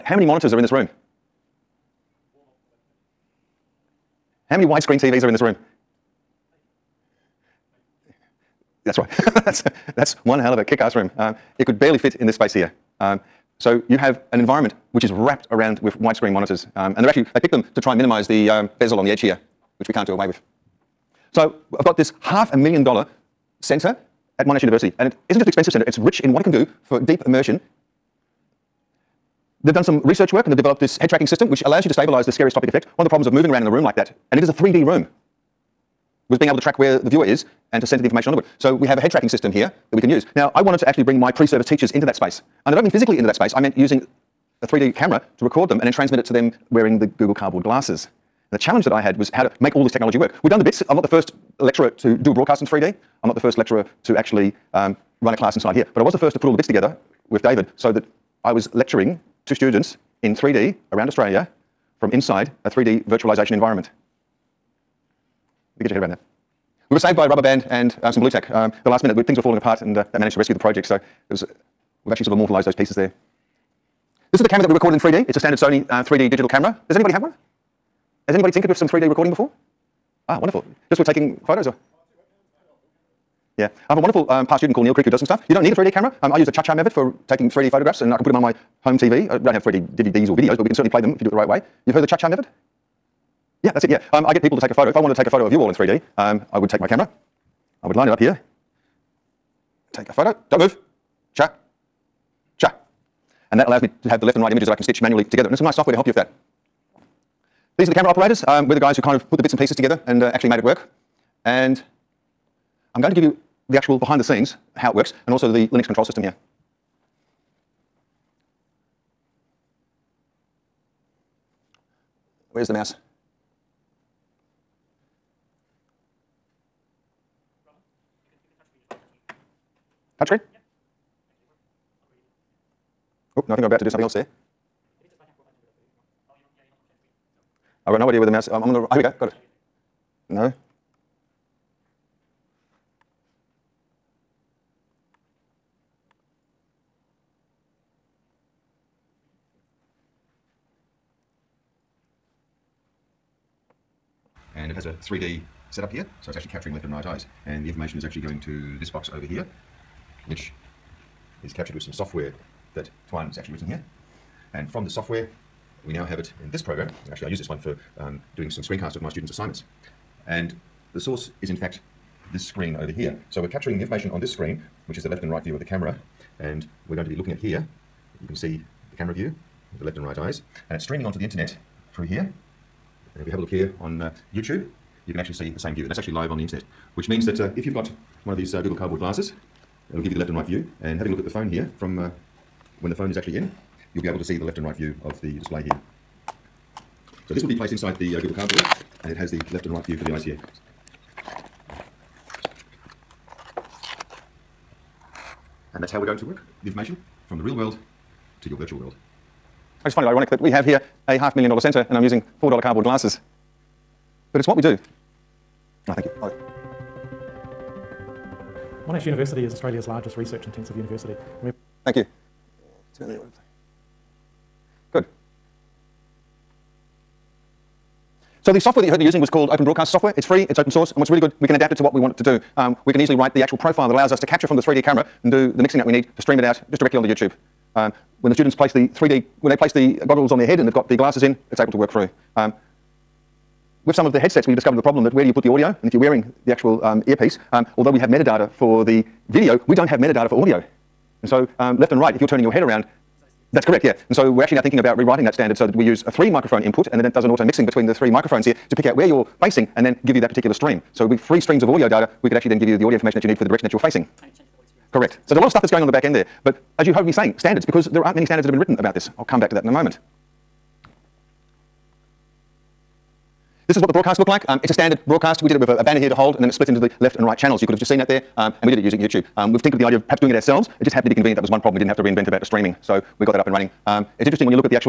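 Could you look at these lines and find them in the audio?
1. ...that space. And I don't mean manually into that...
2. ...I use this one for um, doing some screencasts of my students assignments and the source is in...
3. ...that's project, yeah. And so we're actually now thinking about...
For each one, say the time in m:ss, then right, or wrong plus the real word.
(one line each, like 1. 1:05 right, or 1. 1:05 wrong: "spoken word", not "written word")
1. 0:42 wrong: "physically", not "manually"
2. 2:47 right
3. 4:13 wrong: "correct", not "project".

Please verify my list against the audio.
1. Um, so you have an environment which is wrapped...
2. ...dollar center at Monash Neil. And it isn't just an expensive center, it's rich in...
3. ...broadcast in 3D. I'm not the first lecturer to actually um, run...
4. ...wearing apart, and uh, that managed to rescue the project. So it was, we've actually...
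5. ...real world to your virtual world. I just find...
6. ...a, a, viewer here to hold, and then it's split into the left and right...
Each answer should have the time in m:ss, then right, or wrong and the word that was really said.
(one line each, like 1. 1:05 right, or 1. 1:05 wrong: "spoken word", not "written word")
1. 0:13 right
2. 0:22 wrong: "University", not "Neil"
3. 0:52 right
4. 1:09 wrong: "falling", not "wearing"
5. 3:27 right
6. 4:35 wrong: "banner", not "viewer".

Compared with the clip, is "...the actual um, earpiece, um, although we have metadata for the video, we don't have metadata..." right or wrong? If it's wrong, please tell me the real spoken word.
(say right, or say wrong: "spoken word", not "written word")
right.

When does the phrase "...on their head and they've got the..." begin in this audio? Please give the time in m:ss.
4:00.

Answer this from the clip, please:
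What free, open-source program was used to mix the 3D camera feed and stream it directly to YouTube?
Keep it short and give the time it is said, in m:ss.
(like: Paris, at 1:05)
Open Broadcast Software, at 3:49.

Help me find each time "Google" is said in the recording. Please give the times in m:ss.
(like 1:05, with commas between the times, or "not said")
0:47, 3:08, 3:18.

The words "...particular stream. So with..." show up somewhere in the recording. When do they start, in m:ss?
4:20.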